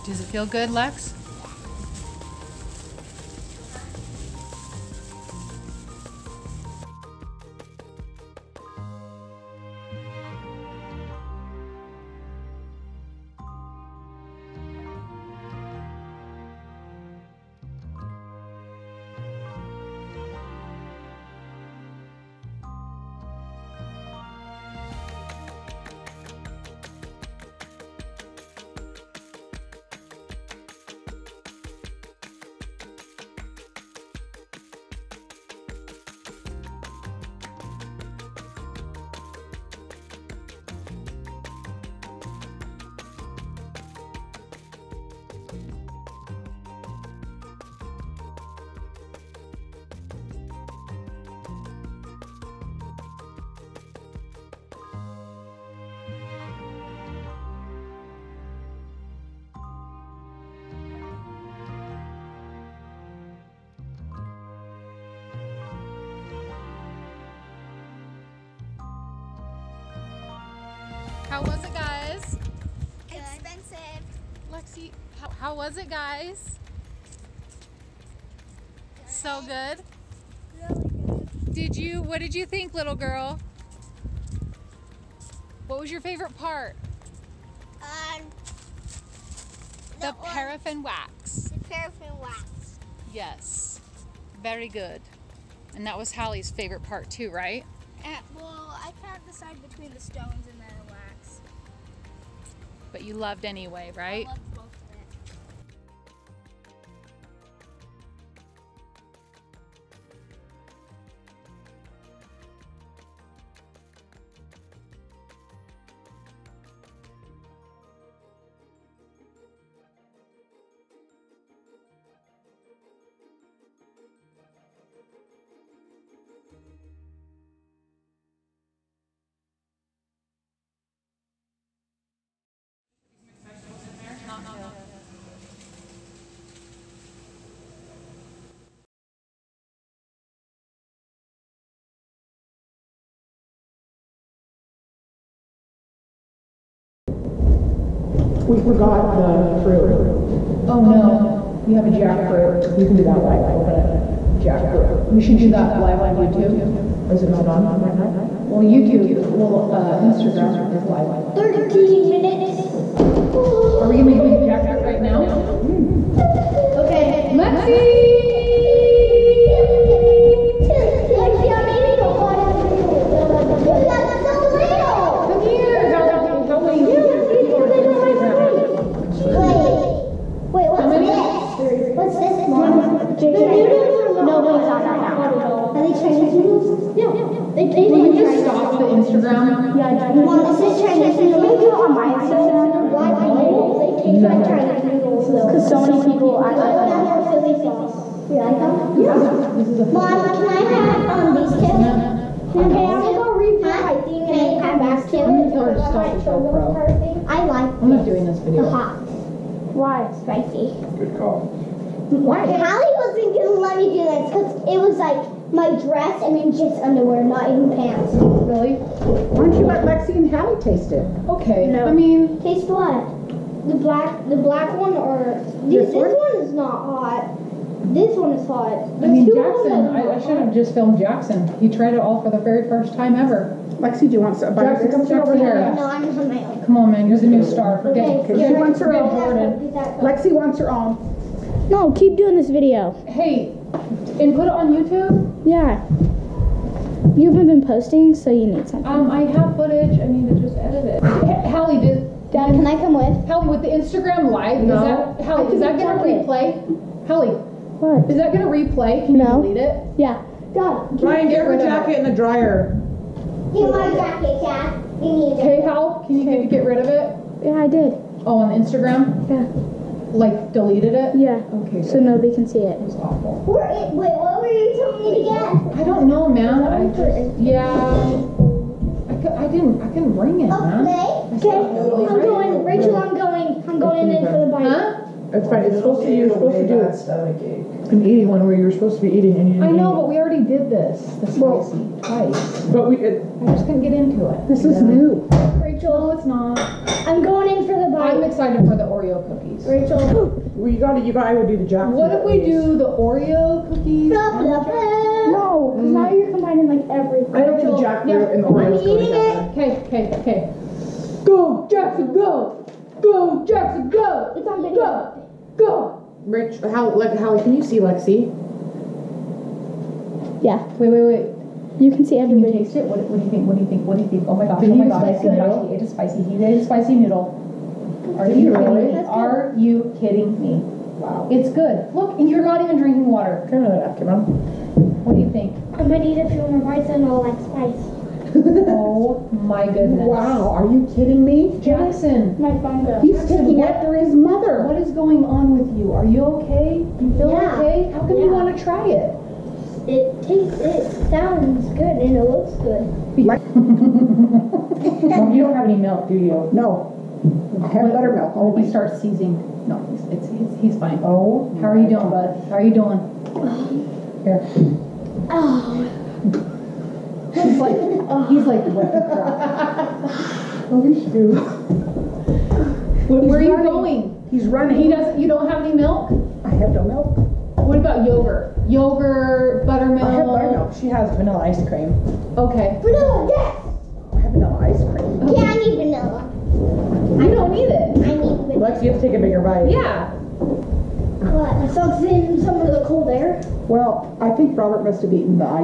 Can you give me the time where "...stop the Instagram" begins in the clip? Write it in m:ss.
3:08.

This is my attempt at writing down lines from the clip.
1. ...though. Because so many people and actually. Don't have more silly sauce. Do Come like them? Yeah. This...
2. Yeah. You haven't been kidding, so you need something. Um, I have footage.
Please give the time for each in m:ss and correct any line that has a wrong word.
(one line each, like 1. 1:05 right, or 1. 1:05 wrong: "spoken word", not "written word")
1. 3:15 wrong: "You", not "Come"
2. 4:05 wrong: "posting", not "kidding".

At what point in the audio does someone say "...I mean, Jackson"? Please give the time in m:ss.
3:49.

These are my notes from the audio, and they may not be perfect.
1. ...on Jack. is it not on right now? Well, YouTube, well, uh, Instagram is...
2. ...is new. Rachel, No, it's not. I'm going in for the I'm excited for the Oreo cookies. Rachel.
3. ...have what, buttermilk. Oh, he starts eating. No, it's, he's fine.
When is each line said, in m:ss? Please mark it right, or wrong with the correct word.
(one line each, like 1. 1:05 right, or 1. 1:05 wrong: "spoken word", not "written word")
1. 2:35 wrong: "YouTube", not "Jack"
2. 4:54 right
3. 5:57 wrong: "seizing", not "eating".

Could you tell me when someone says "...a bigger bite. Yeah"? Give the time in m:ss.
6:29.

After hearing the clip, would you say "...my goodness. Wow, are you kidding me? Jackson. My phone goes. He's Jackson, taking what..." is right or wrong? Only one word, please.
right.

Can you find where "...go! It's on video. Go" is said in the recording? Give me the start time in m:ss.
5:13.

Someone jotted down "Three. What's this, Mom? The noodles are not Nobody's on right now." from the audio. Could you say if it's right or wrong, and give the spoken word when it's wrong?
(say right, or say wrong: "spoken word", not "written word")
right.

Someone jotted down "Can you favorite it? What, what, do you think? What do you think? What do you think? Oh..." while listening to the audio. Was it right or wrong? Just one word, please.
wrong.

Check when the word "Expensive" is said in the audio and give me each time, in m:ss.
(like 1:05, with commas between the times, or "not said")
1:13.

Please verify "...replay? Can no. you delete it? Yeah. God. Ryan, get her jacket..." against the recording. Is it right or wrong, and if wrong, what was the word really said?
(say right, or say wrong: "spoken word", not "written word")
right.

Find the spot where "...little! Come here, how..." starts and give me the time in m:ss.
2:54.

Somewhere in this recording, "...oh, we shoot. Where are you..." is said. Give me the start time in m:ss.
6:10.